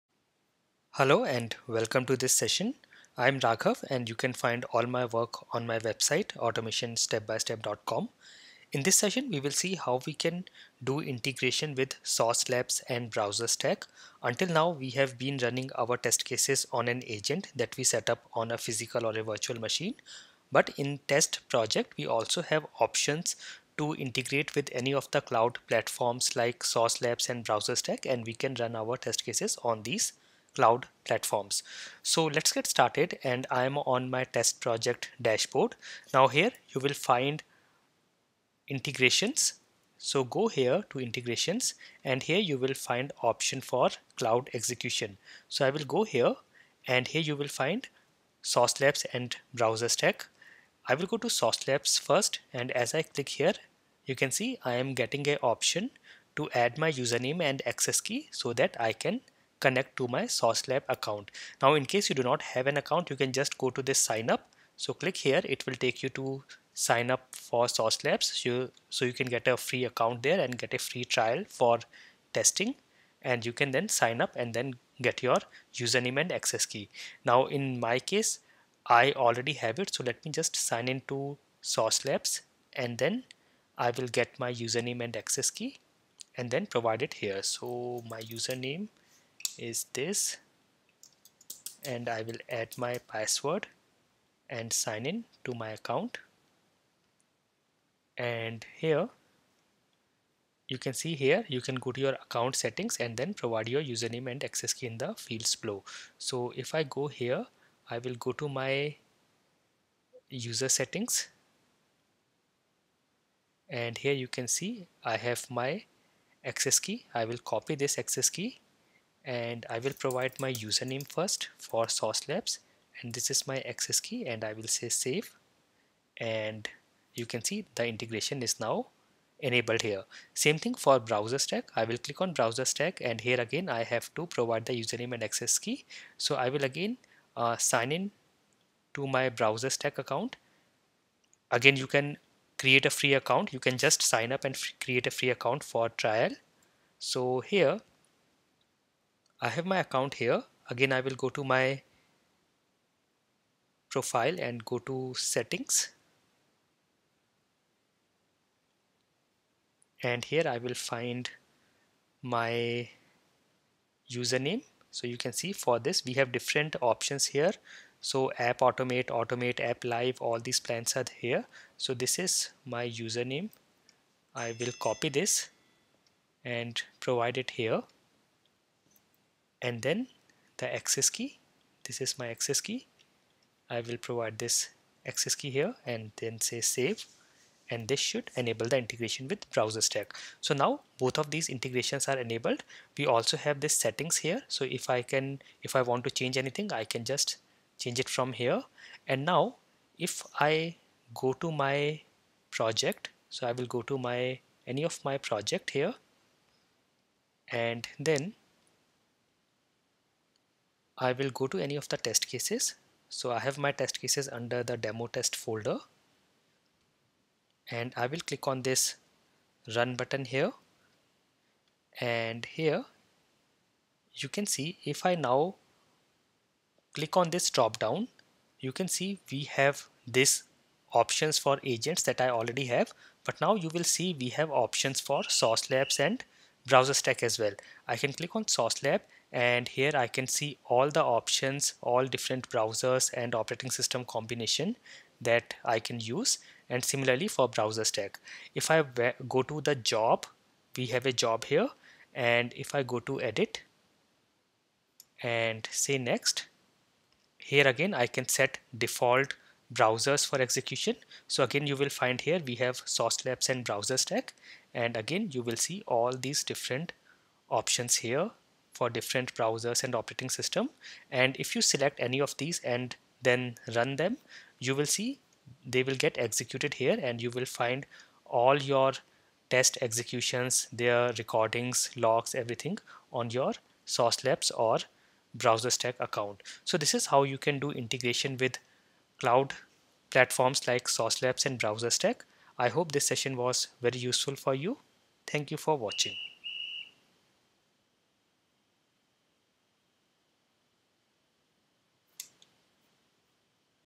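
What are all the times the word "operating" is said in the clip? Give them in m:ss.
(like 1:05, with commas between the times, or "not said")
4:03, 4:29.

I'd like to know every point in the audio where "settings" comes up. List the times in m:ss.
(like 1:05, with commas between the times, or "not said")
1:42, 1:50, 2:35, 3:13.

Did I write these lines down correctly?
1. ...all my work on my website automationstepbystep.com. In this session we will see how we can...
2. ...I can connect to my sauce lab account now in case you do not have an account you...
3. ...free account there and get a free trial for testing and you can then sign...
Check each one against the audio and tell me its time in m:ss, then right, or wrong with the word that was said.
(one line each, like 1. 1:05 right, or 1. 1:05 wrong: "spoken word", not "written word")
1. 0:04 right
2. 0:58 right
3. 1:09 right.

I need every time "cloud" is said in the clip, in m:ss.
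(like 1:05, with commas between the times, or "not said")
0:25, 0:30, 0:44, 4:49.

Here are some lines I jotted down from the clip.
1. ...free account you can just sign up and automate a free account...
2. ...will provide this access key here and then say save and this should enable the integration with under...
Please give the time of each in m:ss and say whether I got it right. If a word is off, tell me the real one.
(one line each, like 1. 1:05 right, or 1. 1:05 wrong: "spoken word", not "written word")
1. 2:22 wrong: "create", not "automate"
2. 3:03 wrong: "browser", not "under".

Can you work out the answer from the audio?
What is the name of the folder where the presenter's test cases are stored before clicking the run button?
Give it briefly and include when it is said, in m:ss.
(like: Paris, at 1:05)
demo test, at 3:34.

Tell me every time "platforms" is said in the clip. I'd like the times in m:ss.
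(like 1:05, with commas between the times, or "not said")
0:25, 0:31, 4:50.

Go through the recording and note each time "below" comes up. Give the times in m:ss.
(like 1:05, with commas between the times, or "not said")
1:45.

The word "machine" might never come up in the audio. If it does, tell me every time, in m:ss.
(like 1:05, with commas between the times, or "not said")
0:19.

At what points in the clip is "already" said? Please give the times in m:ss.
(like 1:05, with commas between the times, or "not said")
1:19, 3:52.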